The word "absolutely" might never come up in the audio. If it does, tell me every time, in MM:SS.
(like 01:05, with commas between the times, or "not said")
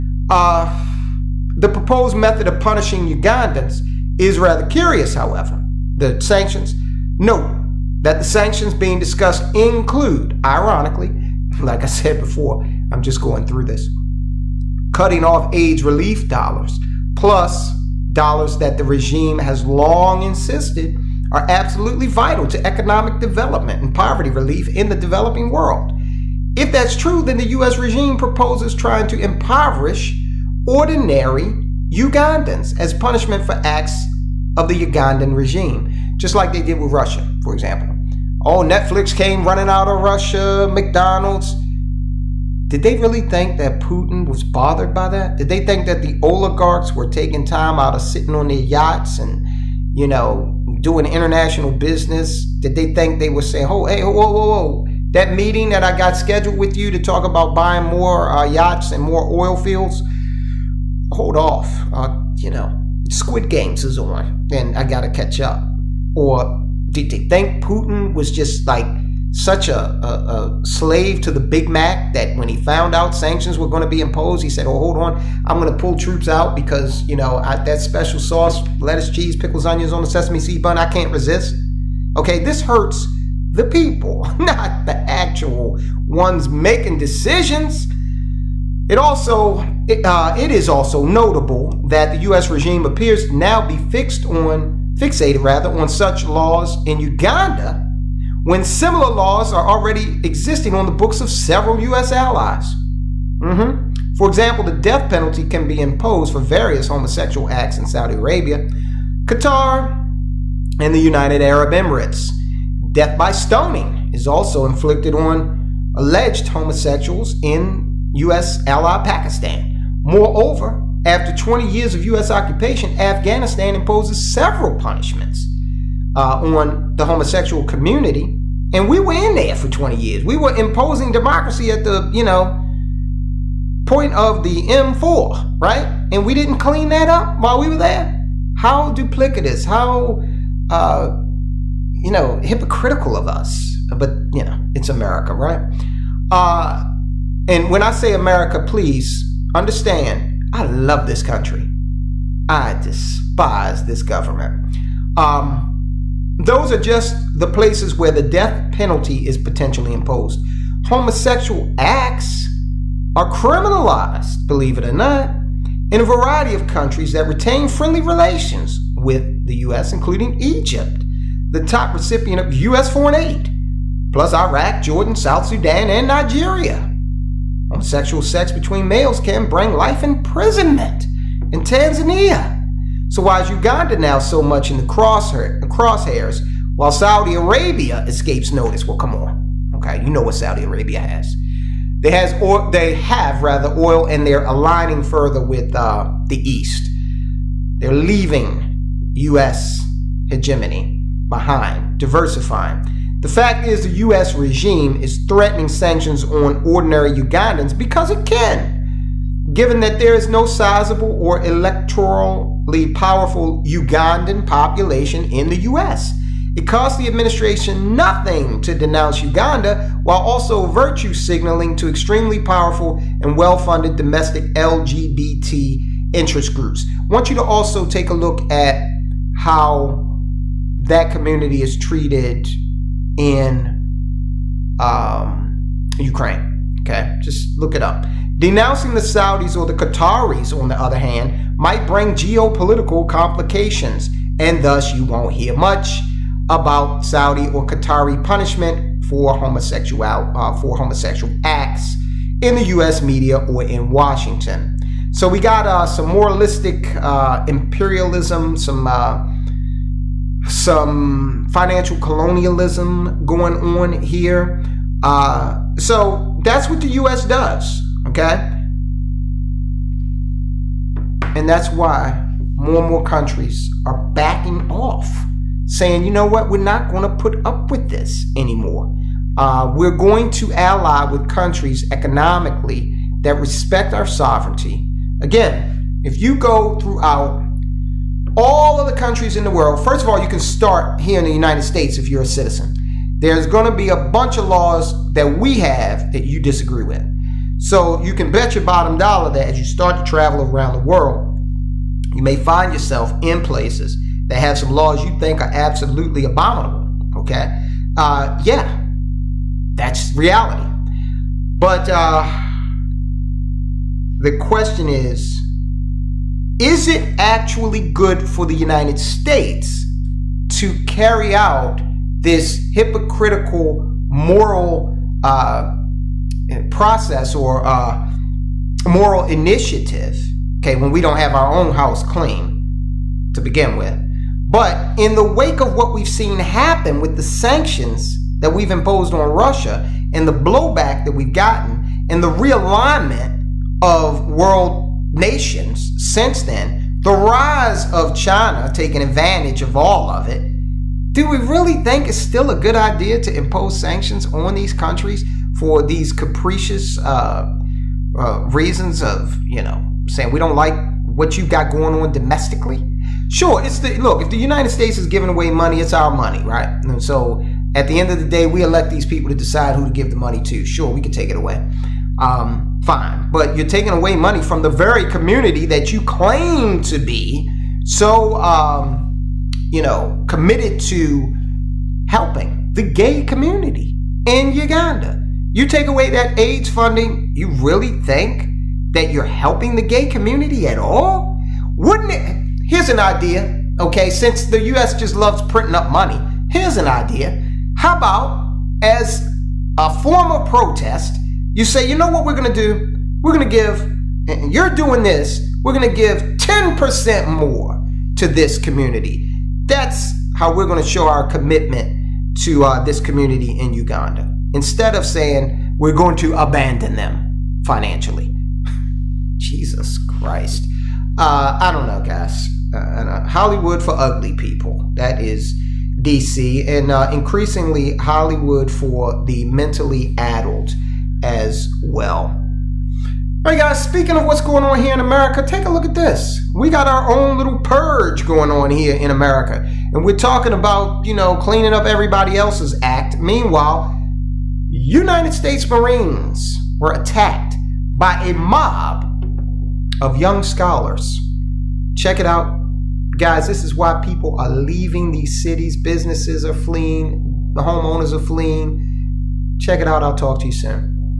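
00:21, 05:05.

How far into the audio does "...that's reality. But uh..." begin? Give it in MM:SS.
05:09.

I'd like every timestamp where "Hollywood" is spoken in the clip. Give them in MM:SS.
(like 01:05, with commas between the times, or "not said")
07:03, 07:07.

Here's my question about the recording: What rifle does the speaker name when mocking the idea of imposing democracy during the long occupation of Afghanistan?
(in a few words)
M4.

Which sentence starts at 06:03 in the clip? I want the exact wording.
Sure, it's the look, if the United States is giving away money, it's our money, right?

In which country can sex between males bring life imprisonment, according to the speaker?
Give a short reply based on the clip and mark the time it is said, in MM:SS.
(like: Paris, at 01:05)
Tanzania, at 03:01.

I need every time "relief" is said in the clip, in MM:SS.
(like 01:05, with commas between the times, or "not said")
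00:15, 00:24.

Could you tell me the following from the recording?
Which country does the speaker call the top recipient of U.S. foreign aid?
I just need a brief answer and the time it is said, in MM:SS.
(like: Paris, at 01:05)
Egypt, at 02:50.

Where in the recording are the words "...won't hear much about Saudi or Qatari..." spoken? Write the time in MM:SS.
04:05.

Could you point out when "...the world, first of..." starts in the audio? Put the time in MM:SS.
04:49.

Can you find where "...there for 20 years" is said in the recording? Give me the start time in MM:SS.
02:09.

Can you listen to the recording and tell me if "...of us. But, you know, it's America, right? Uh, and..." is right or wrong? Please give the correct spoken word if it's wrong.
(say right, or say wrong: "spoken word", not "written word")
right.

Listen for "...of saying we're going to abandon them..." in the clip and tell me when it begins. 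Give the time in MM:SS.
06:54.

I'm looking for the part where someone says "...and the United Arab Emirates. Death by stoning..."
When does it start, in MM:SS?
01:50.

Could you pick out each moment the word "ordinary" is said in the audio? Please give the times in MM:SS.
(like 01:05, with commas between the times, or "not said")
00:30, 03:26.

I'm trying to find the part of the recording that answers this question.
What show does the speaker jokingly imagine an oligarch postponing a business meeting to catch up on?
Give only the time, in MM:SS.
01:03.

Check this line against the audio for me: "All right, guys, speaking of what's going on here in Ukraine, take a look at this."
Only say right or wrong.
wrong.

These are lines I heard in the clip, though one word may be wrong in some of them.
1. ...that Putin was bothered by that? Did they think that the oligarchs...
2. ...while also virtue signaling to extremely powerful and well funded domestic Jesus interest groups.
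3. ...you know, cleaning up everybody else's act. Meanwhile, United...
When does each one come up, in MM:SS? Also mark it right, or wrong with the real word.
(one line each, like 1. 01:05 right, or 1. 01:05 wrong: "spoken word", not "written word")
1. 00:43 right
2. 03:40 wrong: "LGBT", not "Jesus"
3. 07:21 right.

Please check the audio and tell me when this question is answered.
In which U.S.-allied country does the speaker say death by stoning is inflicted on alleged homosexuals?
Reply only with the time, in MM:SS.
01:59.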